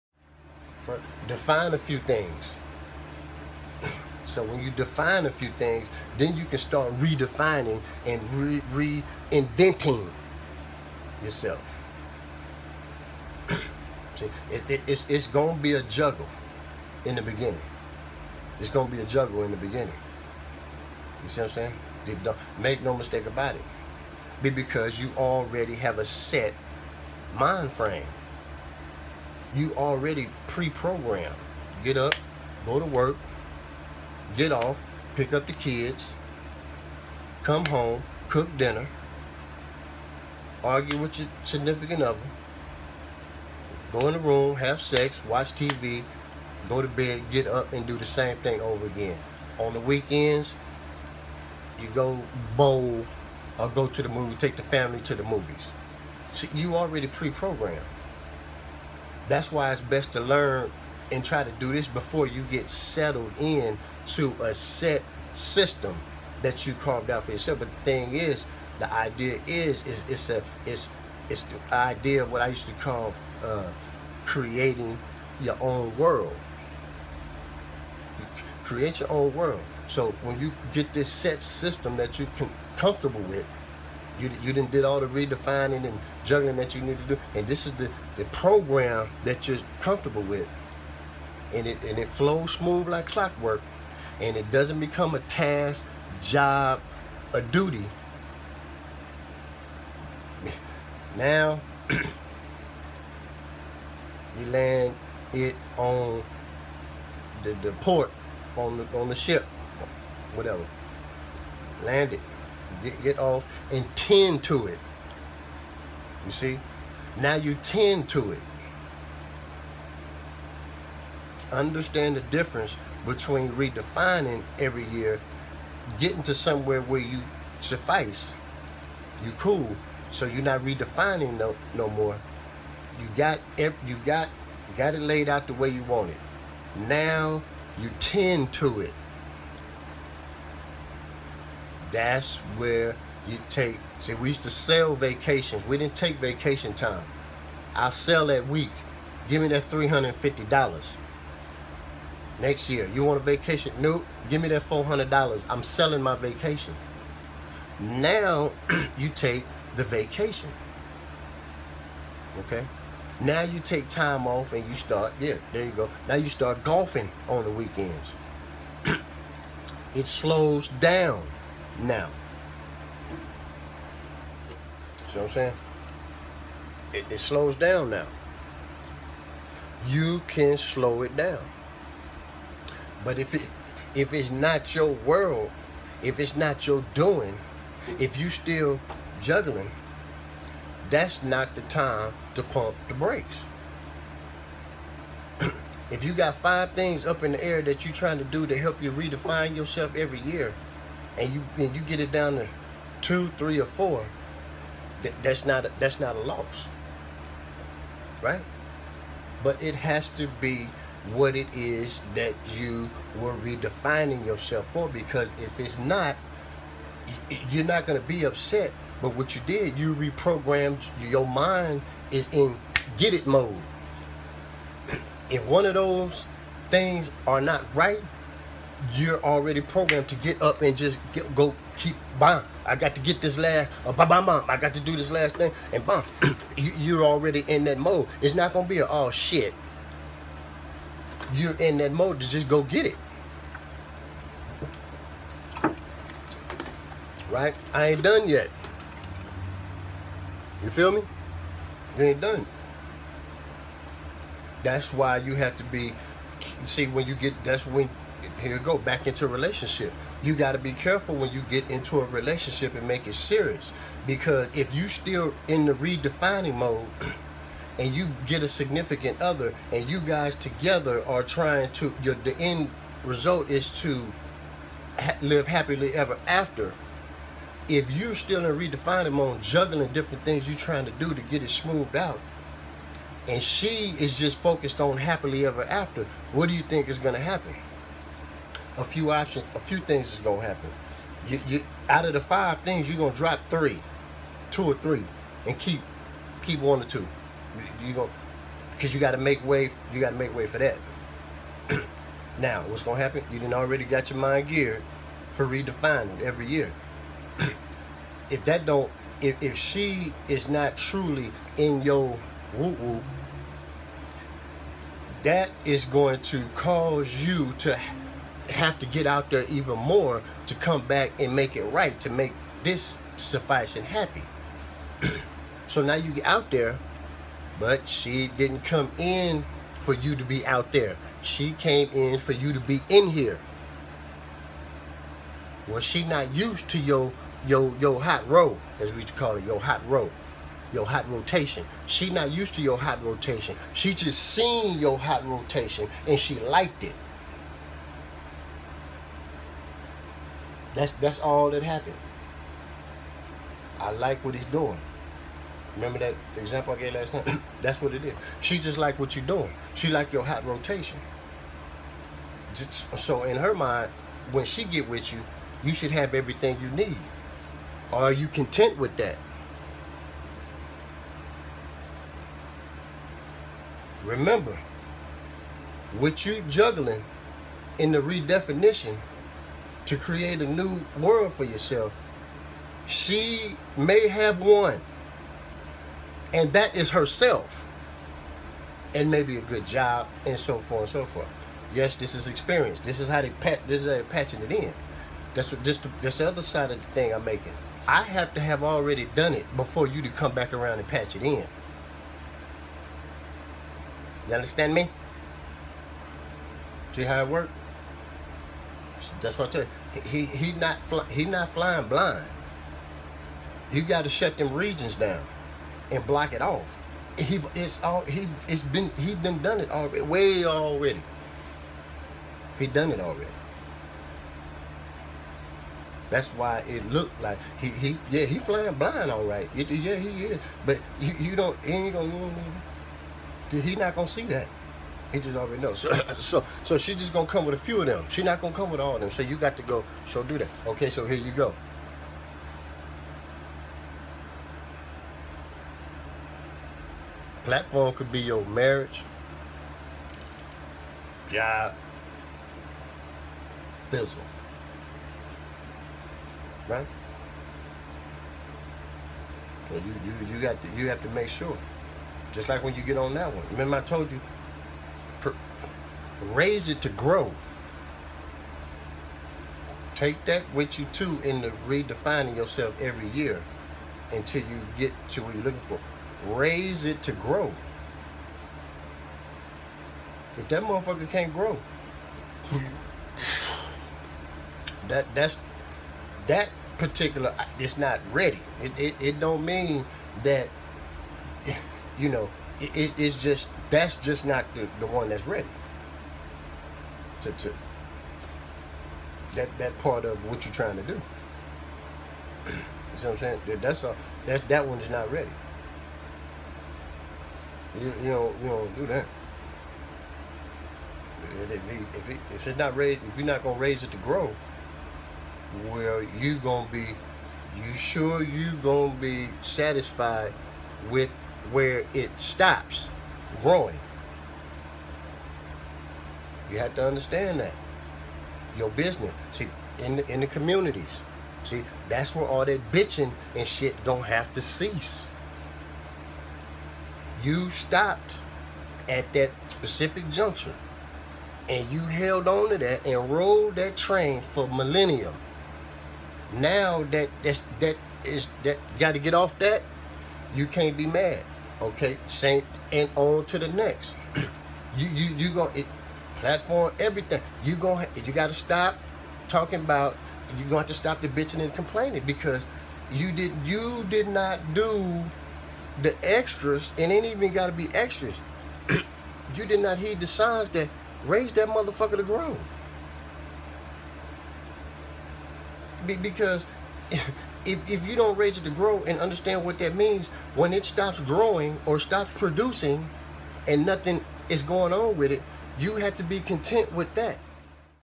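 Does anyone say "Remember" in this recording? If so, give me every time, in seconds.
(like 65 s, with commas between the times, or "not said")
355 s, 374 s, 463 s.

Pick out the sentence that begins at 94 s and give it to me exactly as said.
And it doesn't become a task, job, a duty.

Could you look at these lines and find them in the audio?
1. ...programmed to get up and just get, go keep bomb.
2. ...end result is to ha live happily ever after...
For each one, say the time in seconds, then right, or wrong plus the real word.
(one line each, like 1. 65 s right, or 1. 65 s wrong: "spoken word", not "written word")
1. 229 s right
2. 272 s right.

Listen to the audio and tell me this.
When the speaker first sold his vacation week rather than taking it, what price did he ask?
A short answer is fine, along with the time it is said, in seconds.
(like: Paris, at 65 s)
$350, at 149 s.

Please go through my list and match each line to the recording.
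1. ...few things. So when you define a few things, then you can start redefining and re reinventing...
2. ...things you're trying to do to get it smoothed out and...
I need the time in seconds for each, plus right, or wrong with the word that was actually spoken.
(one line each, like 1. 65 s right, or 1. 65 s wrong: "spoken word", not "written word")
1. 1 s right
2. 280 s right.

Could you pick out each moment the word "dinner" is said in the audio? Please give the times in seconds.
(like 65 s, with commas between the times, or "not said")
38 s.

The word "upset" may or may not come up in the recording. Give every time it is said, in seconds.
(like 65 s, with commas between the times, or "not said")
218 s.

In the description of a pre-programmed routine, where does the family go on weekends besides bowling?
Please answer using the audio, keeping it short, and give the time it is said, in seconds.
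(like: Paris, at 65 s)
The movies, at 55 s.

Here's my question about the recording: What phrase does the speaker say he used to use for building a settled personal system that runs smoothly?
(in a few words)
Creating your own world.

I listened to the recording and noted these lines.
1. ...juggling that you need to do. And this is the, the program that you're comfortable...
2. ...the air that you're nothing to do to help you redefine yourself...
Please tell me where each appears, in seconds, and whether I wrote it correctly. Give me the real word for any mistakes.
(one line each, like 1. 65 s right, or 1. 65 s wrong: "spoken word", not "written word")
1. 86 s right
2. 197 s wrong: "trying", not "nothing".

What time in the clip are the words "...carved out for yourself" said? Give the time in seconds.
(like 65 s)
66 s.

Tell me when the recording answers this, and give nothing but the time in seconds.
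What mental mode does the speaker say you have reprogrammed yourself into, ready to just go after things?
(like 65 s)
222 s.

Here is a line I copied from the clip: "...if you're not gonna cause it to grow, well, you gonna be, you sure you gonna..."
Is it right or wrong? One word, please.
wrong.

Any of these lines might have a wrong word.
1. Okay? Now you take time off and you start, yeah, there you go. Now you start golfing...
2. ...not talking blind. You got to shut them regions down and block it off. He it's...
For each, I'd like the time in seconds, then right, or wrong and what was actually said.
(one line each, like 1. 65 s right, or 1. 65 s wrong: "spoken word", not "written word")
1. 162 s right
2. 411 s wrong: "flying", not "talking".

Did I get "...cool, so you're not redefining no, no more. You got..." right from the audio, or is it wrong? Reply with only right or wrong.
right.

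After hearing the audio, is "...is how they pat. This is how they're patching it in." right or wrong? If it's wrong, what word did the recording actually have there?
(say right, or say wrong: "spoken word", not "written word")
right.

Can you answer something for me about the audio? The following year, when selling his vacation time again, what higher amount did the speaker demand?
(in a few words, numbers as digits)
$400.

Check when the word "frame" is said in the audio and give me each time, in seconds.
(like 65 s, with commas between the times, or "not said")
27 s.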